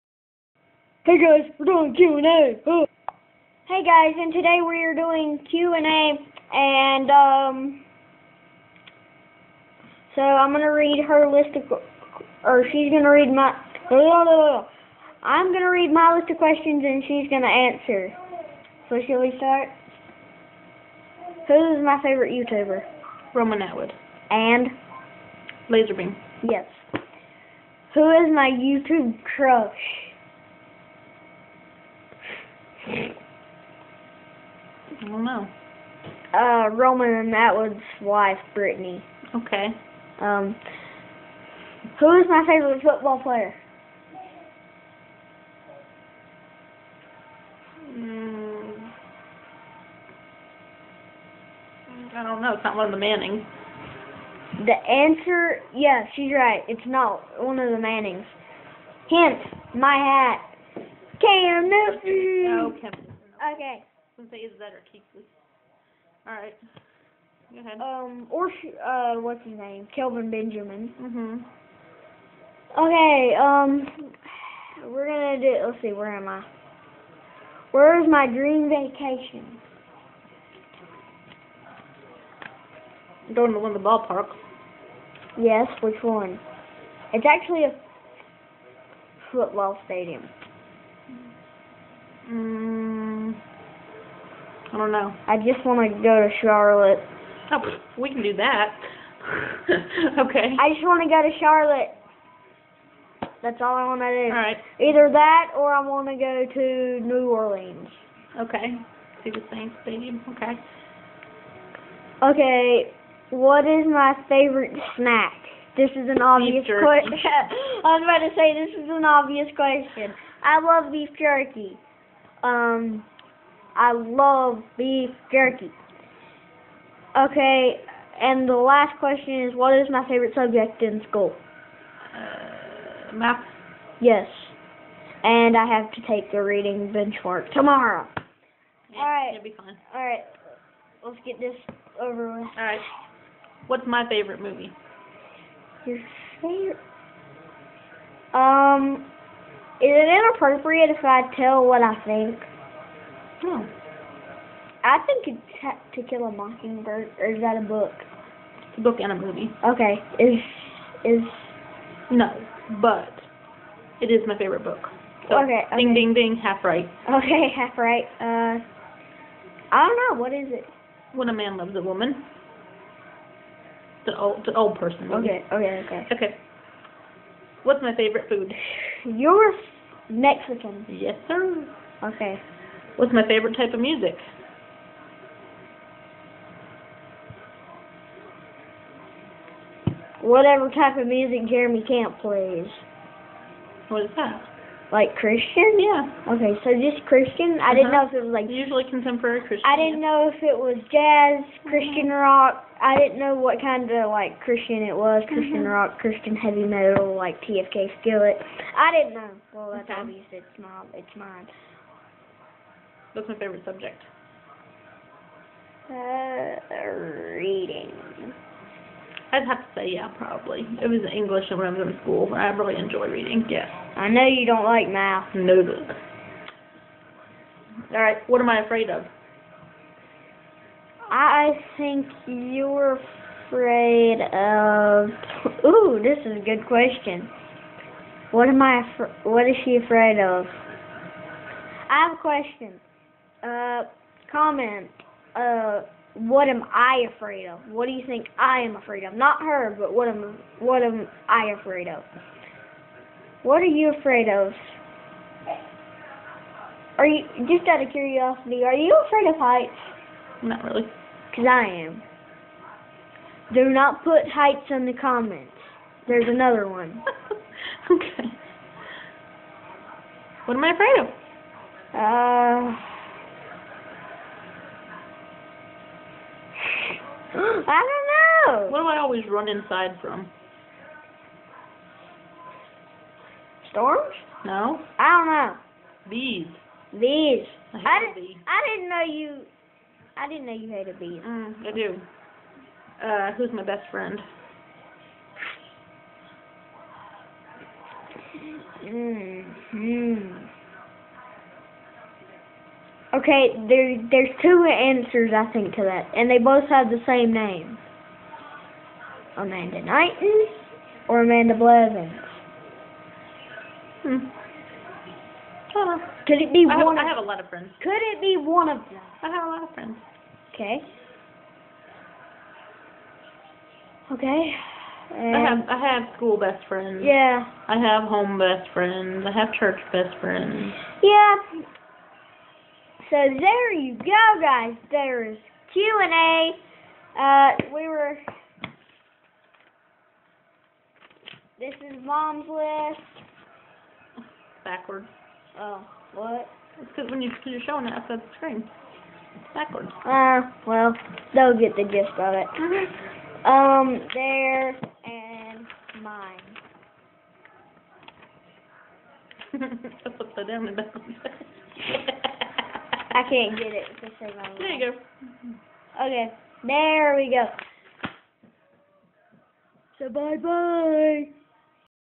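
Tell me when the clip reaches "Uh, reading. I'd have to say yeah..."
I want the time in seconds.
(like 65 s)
215 s.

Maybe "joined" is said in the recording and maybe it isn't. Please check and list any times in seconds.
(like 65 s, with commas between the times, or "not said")
not said.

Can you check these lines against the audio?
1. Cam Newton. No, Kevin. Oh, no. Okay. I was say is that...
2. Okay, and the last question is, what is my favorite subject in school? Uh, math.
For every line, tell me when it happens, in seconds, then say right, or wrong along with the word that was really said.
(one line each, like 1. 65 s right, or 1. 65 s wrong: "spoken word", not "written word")
1. 61 s right
2. 127 s right.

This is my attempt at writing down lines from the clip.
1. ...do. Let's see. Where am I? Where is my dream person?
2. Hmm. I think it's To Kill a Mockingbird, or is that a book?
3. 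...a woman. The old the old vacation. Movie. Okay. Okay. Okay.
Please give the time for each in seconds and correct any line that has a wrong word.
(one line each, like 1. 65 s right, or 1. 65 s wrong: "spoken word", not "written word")
1. 75 s wrong: "vacation", not "person"
2. 153 s right
3. 171 s wrong: "person", not "vacation".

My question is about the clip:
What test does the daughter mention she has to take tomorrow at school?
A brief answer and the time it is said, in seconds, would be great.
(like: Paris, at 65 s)
Reading benchmark, at 136 s.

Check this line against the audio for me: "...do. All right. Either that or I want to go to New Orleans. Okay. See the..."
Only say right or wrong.
right.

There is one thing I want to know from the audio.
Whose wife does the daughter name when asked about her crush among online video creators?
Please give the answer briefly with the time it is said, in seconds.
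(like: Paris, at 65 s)
Roman Atwood, at 36 s.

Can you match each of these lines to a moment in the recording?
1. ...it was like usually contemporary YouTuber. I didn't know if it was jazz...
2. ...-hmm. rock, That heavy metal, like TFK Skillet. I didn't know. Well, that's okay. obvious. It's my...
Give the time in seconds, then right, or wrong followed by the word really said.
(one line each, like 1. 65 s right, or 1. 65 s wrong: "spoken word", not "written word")
1. 198 s wrong: "Christian", not "YouTuber"
2. 205 s wrong: "Christian", not "That".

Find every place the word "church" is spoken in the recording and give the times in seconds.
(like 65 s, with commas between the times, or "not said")
329 s.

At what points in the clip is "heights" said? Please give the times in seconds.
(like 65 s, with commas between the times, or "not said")
259 s, 264 s.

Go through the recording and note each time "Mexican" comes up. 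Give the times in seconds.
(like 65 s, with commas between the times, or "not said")
180 s.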